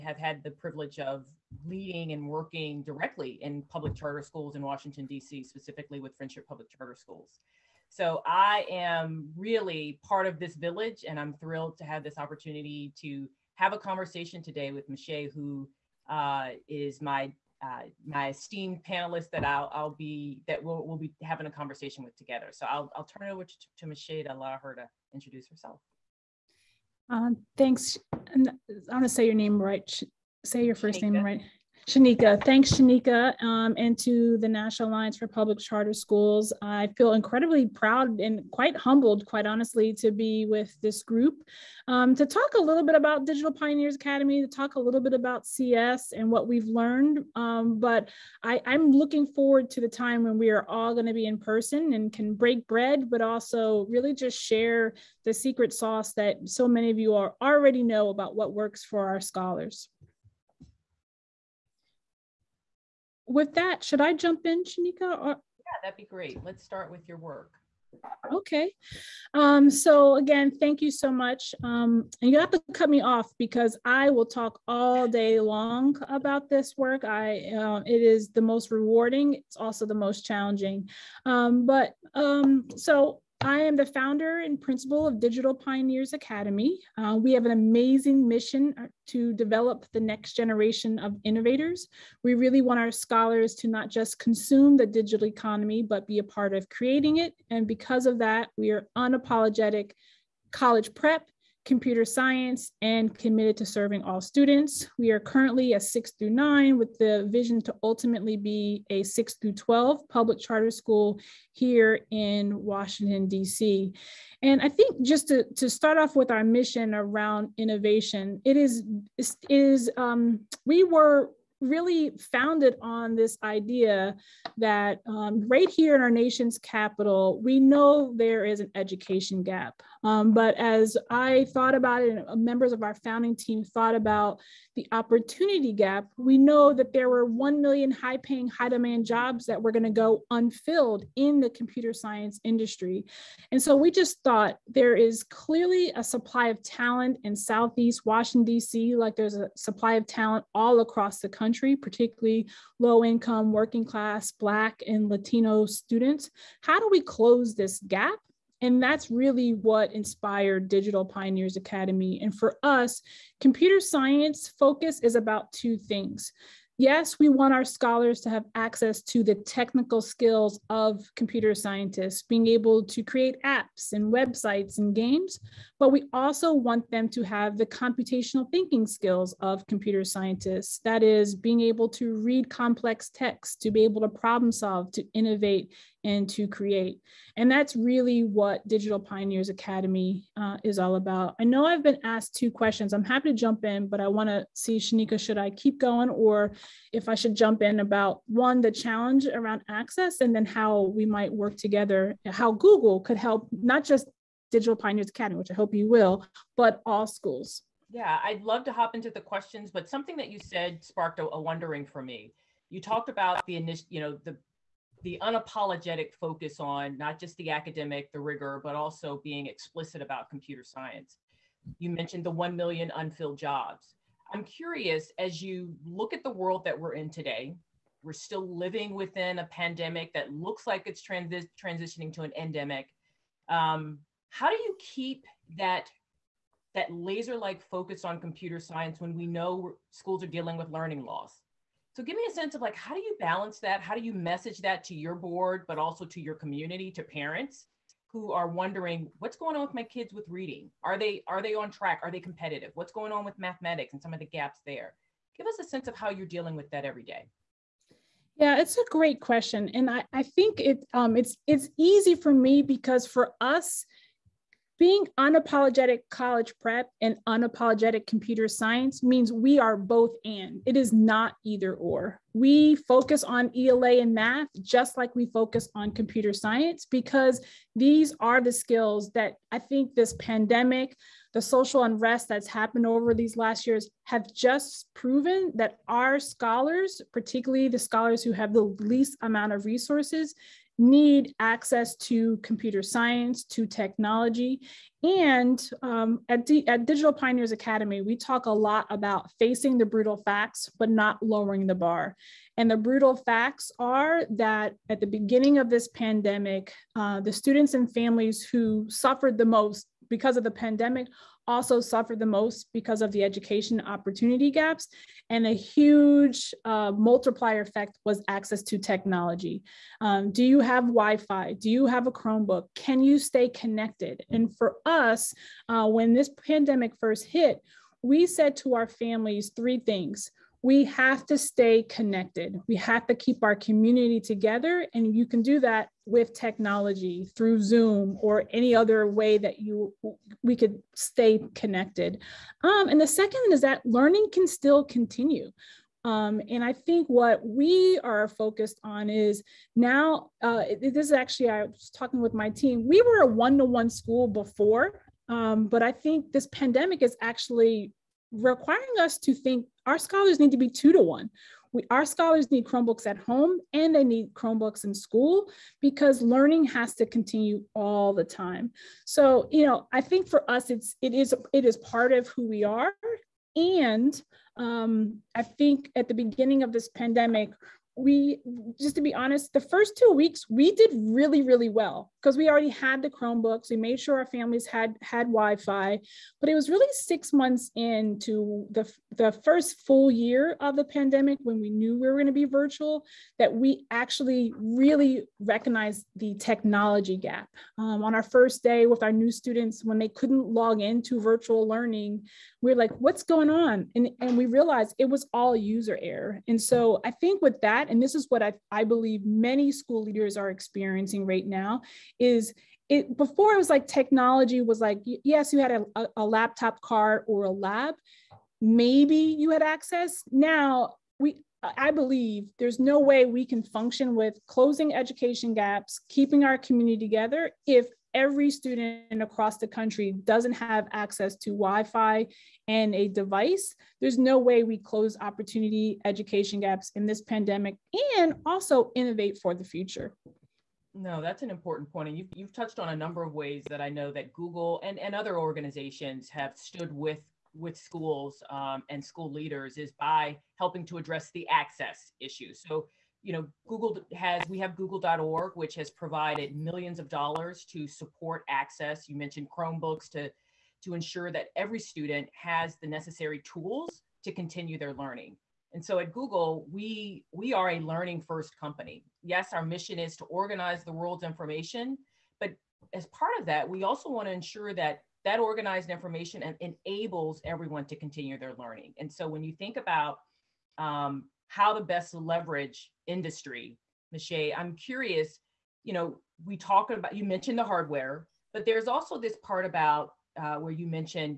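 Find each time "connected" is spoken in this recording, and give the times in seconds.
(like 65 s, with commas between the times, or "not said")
323 s, 331 s, 341 s.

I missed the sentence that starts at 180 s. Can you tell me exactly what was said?
That is, being able to read complex text, to be able to problem solve, to innovate, and to create.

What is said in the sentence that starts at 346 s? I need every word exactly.
Um, and I think what we are focused on is now, uh, this is actually, I was talking with my team.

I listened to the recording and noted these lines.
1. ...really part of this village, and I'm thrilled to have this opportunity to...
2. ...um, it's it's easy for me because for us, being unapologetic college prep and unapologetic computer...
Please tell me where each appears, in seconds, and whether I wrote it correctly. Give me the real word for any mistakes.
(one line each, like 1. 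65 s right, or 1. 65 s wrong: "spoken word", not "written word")
1. 9 s right
2. 260 s right.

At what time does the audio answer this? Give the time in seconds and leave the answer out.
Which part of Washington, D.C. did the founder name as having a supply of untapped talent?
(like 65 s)
147 s.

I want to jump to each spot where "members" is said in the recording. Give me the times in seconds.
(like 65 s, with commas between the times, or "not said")
132 s.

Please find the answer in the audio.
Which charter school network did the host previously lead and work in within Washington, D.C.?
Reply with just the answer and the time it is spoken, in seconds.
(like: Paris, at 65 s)
Friendship Public Charter Schools, at 6 s.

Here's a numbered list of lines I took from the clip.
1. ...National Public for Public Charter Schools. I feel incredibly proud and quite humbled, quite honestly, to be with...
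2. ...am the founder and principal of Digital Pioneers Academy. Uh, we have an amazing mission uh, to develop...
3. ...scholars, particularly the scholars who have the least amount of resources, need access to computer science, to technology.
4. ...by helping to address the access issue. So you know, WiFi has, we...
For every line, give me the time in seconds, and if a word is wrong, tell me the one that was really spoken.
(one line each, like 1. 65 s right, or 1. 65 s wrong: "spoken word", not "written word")
1. 34 s wrong: "Alliance", not "Public"
2. 83 s right
3. 286 s right
4. 449 s wrong: "Google", not "WiFi".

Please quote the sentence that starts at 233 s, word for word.
Um, how do you keep that that laser-like focus on computer science when we know schools are dealing with learning loss?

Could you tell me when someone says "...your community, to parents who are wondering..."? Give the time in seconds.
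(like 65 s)
246 s.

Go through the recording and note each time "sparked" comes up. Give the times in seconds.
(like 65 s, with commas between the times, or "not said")
210 s.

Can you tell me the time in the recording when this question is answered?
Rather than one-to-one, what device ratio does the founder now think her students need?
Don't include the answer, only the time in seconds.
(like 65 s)
360 s.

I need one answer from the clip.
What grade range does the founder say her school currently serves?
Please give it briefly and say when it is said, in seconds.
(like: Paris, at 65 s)
6 through 9, at 105 s.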